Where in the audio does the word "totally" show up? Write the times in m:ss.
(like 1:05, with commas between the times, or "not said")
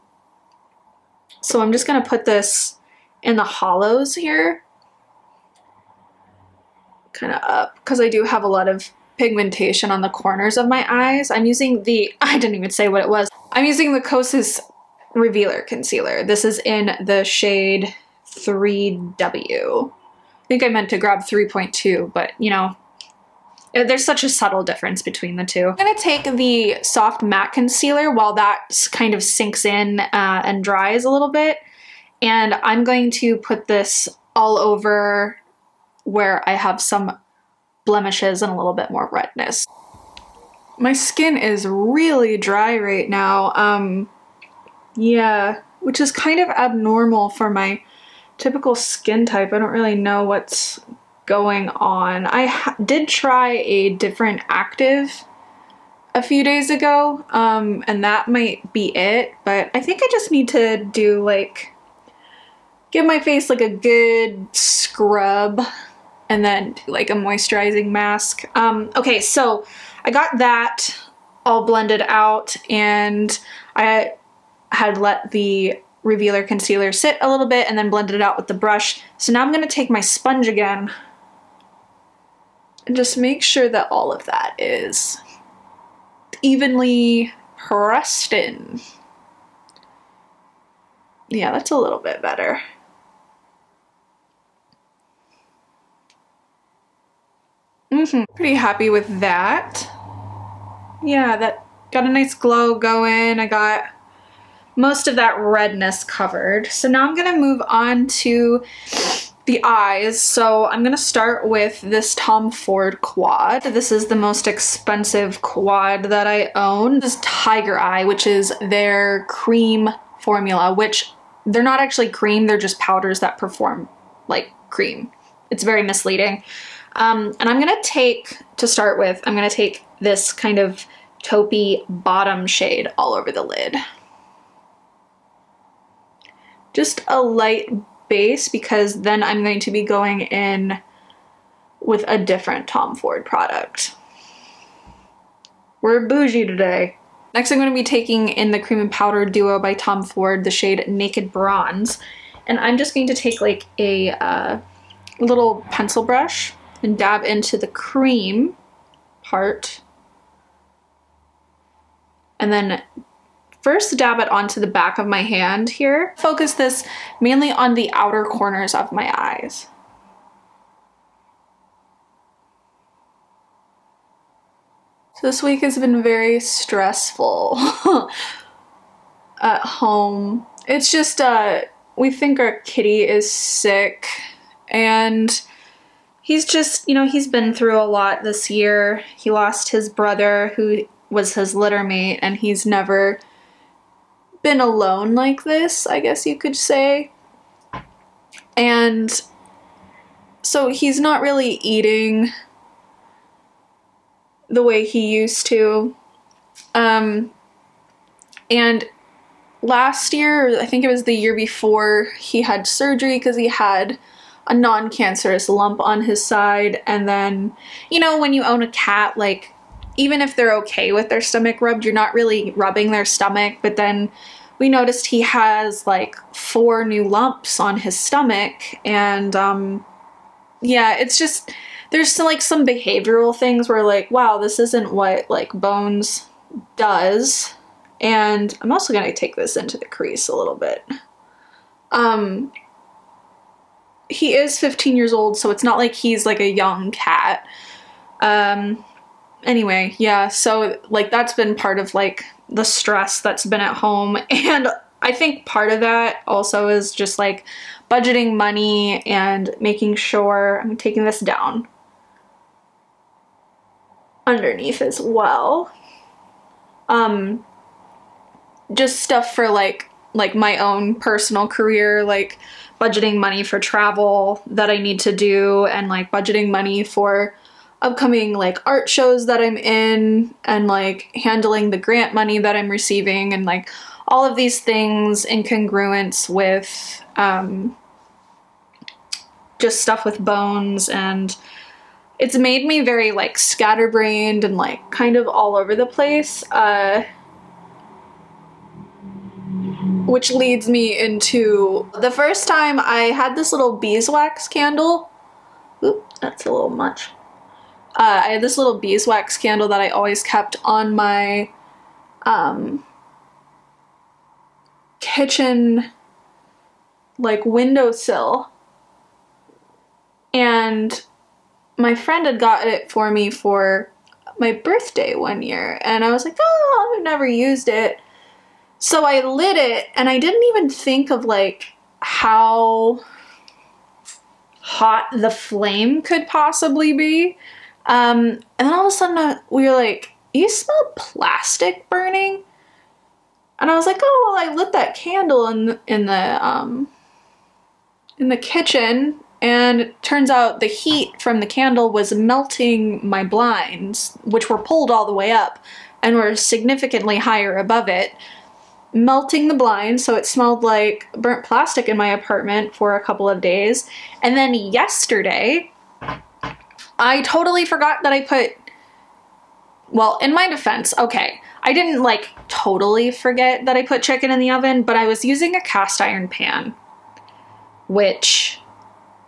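6:07, 6:12.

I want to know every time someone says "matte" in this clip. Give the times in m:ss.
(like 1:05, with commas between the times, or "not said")
0:27.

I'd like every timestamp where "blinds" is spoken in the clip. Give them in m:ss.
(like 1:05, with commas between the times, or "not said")
5:53, 5:59.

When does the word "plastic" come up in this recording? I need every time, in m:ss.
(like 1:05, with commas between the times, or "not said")
5:40, 6:01.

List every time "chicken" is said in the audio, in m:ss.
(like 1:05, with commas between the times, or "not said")
6:14.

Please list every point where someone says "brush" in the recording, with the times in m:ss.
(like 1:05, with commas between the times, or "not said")
1:18, 2:36.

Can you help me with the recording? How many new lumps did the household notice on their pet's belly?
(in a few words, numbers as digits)
4.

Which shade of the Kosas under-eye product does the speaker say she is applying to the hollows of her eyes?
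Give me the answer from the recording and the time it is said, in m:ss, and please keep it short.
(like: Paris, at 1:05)
3W, at 0:18.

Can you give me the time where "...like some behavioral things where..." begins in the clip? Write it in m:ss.
3:52.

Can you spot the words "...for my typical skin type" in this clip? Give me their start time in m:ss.
0:47.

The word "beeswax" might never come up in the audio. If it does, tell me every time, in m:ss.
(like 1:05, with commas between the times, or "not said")
5:03, 5:08.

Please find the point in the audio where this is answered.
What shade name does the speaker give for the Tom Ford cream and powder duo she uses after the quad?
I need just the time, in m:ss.
2:30.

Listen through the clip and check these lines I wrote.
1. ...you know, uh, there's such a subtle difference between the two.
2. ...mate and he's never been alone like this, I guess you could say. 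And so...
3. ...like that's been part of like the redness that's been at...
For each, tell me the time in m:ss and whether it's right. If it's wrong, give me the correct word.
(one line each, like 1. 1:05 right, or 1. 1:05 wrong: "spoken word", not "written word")
1. 0:22 right
2. 3:11 right
3. 4:10 wrong: "stress", not "redness".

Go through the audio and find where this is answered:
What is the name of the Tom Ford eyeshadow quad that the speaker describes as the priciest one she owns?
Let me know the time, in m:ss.
1:57.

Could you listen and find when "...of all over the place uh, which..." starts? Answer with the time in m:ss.
4:55.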